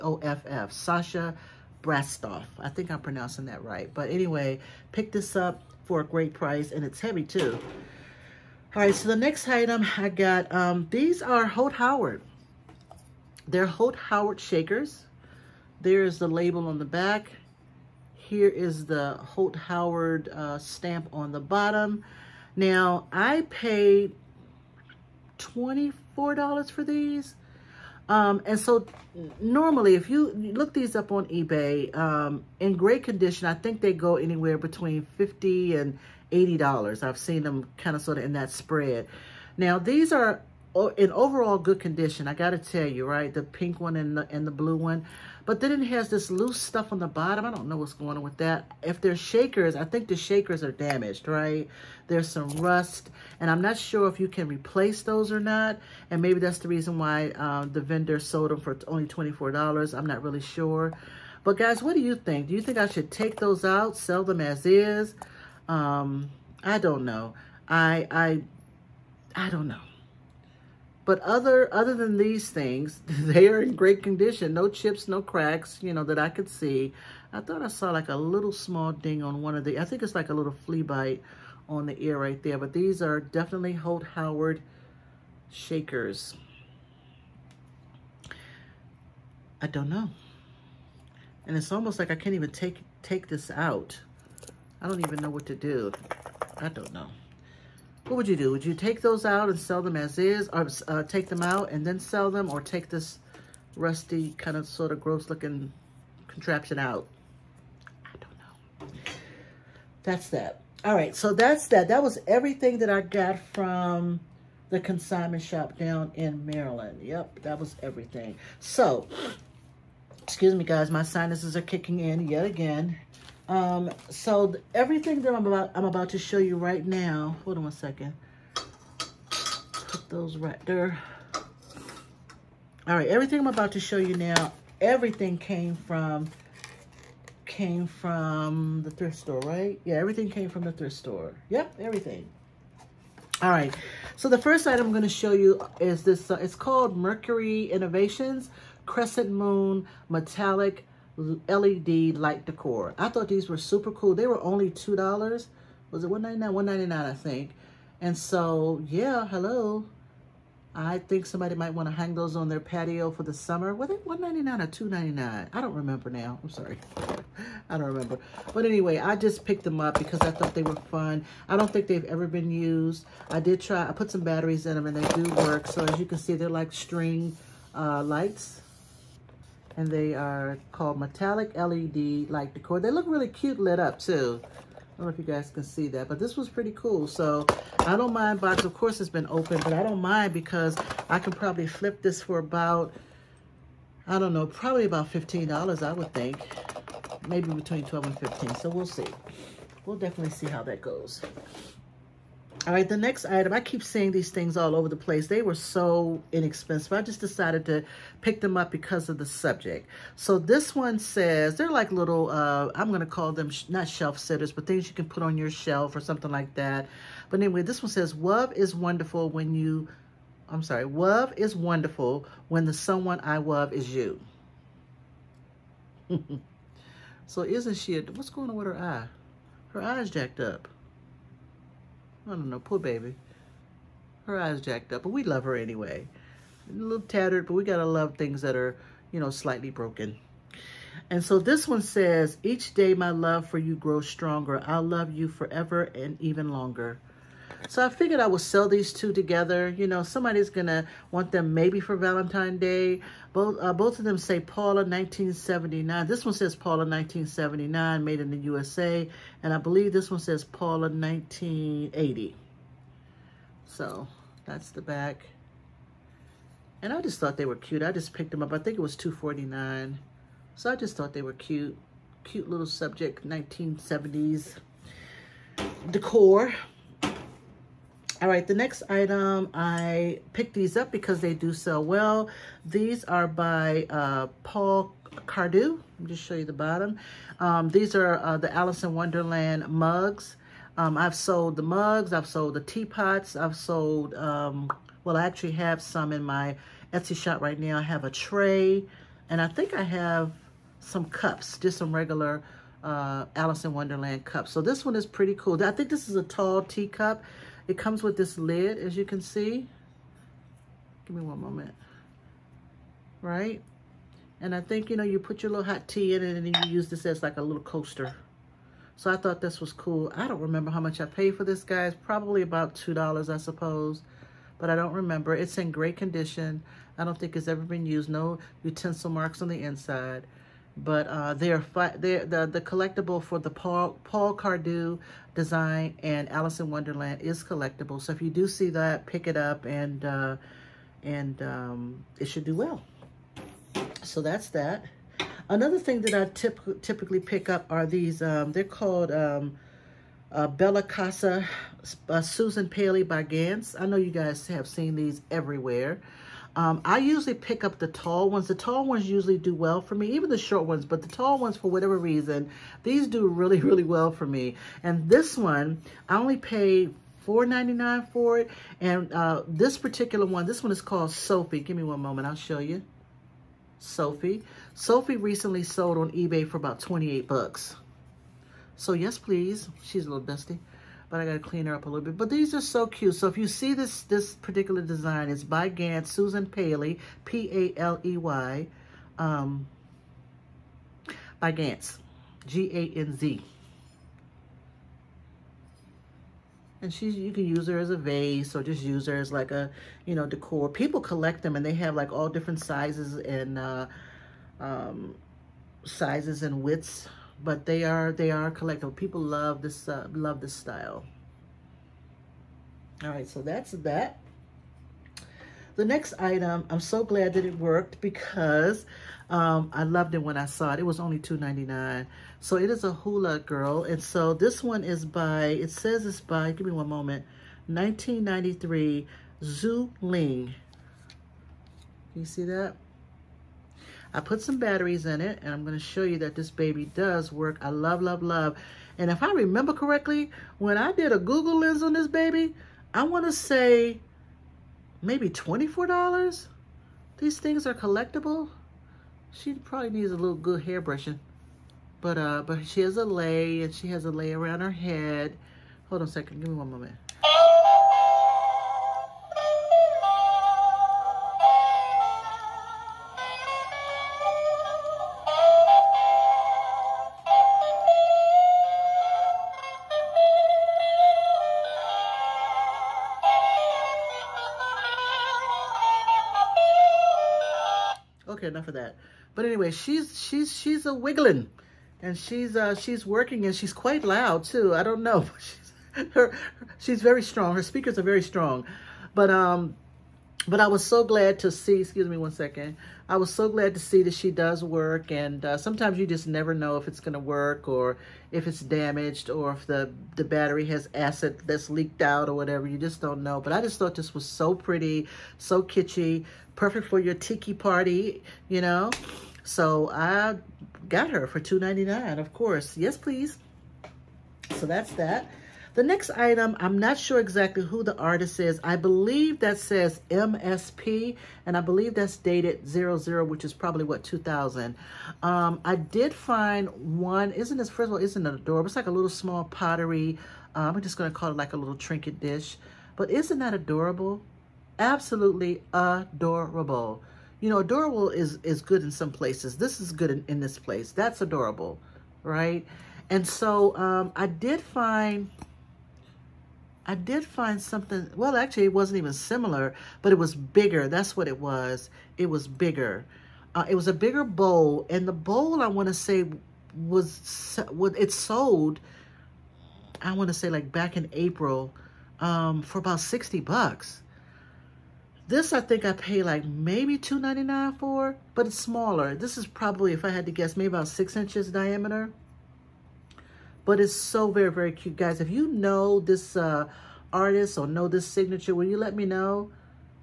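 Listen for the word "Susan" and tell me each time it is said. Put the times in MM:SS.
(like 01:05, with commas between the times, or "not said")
05:52, 06:26.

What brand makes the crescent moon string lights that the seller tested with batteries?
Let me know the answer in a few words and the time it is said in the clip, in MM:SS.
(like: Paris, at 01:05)
Mercury Innovations, at 02:26.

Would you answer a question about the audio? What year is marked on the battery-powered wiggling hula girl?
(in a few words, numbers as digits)
1993.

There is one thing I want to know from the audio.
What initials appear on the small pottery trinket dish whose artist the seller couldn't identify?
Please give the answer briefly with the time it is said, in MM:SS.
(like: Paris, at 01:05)
MSP, at 08:40.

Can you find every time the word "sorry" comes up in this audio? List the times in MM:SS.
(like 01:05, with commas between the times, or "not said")
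02:46, 03:40.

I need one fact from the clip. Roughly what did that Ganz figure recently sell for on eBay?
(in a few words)
$28.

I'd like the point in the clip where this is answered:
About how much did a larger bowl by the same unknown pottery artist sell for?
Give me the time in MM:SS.
09:22.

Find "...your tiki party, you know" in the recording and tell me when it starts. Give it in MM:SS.
08:26.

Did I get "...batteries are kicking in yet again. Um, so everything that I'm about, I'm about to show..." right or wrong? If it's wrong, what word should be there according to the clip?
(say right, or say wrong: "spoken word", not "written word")
wrong: "sinuses", not "batteries".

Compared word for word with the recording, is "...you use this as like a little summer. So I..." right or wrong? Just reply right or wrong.
wrong.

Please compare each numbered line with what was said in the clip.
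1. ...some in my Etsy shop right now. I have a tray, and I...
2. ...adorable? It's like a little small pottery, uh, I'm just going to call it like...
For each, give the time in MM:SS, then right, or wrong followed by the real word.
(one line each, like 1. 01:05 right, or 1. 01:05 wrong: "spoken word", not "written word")
1. 04:55 right
2. 08:48 right.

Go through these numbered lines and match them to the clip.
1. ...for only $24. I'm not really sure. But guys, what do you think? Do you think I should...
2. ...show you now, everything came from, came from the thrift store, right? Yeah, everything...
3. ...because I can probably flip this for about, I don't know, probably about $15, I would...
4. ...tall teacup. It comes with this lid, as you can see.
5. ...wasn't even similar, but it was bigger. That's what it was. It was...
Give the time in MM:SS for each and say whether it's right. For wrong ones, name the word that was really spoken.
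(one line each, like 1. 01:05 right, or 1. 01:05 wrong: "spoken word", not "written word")
1. 00:58 right
2. 02:13 right
3. 03:10 right
4. 05:06 right
5. 09:08 right.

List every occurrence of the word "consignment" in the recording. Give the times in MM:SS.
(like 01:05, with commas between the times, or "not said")
01:54.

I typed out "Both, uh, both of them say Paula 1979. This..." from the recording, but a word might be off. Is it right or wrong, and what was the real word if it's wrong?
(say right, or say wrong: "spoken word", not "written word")
right.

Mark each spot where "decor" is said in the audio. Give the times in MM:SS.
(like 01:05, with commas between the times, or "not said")
02:32, 03:02, 04:35, 06:40.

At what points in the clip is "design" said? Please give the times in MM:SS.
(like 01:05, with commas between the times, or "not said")
05:35, 06:24.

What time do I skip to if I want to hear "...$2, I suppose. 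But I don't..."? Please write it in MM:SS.
05:22.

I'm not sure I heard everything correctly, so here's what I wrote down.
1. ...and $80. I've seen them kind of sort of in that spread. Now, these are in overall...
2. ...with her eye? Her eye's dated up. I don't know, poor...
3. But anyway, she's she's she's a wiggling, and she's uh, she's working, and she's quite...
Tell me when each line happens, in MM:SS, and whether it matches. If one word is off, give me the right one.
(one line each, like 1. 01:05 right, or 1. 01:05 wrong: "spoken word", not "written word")
1. 00:35 right
2. 03:48 wrong: "jacked", not "dated"
3. 07:59 right.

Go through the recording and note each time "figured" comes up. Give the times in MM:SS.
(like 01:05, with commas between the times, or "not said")
04:07.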